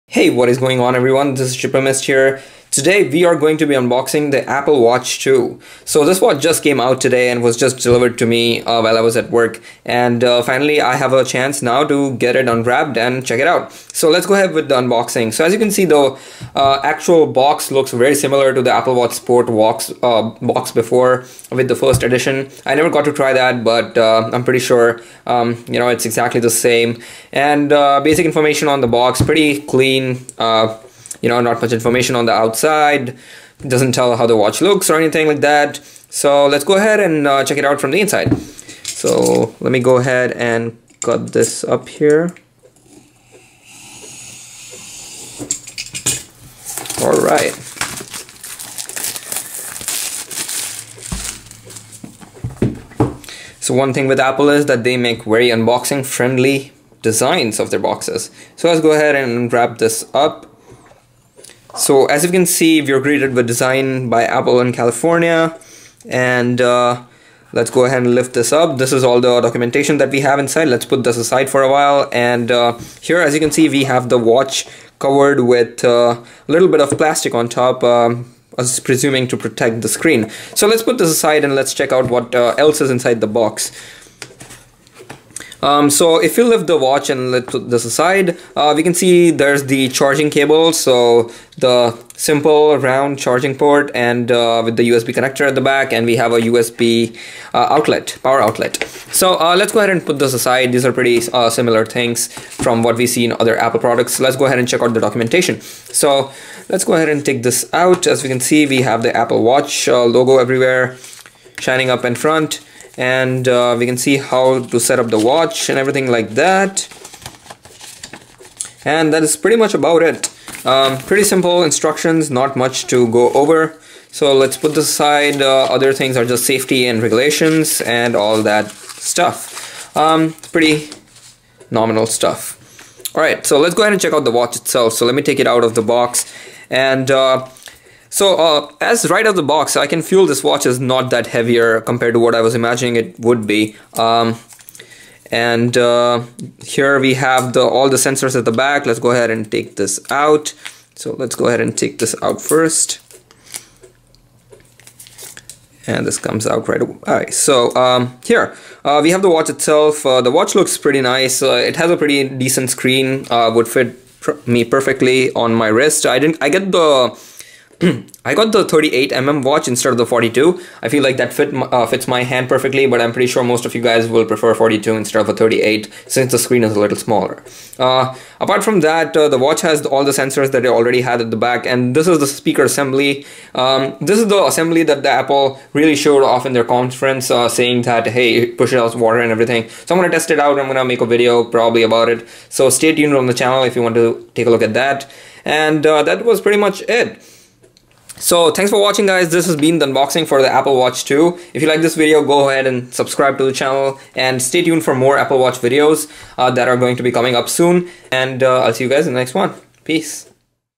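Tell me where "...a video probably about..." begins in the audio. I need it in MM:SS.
03:11.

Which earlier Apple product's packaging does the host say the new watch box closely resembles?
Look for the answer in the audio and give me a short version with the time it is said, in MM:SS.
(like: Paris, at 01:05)
Apple Watch Sport, at 00:18.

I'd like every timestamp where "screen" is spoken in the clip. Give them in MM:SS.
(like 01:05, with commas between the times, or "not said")
01:19, 02:42, 02:56.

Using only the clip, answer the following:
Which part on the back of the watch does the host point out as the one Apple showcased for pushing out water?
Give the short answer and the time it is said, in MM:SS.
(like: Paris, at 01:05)
speaker assembly, at 03:02.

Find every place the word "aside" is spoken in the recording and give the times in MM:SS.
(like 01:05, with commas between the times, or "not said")
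01:11, 01:21, 01:27, 01:40, 02:04.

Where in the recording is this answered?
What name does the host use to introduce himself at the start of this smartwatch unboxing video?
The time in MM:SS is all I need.
00:01.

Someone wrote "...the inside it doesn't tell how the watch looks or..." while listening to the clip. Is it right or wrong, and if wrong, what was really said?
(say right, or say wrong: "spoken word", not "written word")
wrong: "outside", not "inside".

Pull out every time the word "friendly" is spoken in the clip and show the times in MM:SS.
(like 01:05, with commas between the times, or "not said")
00:56.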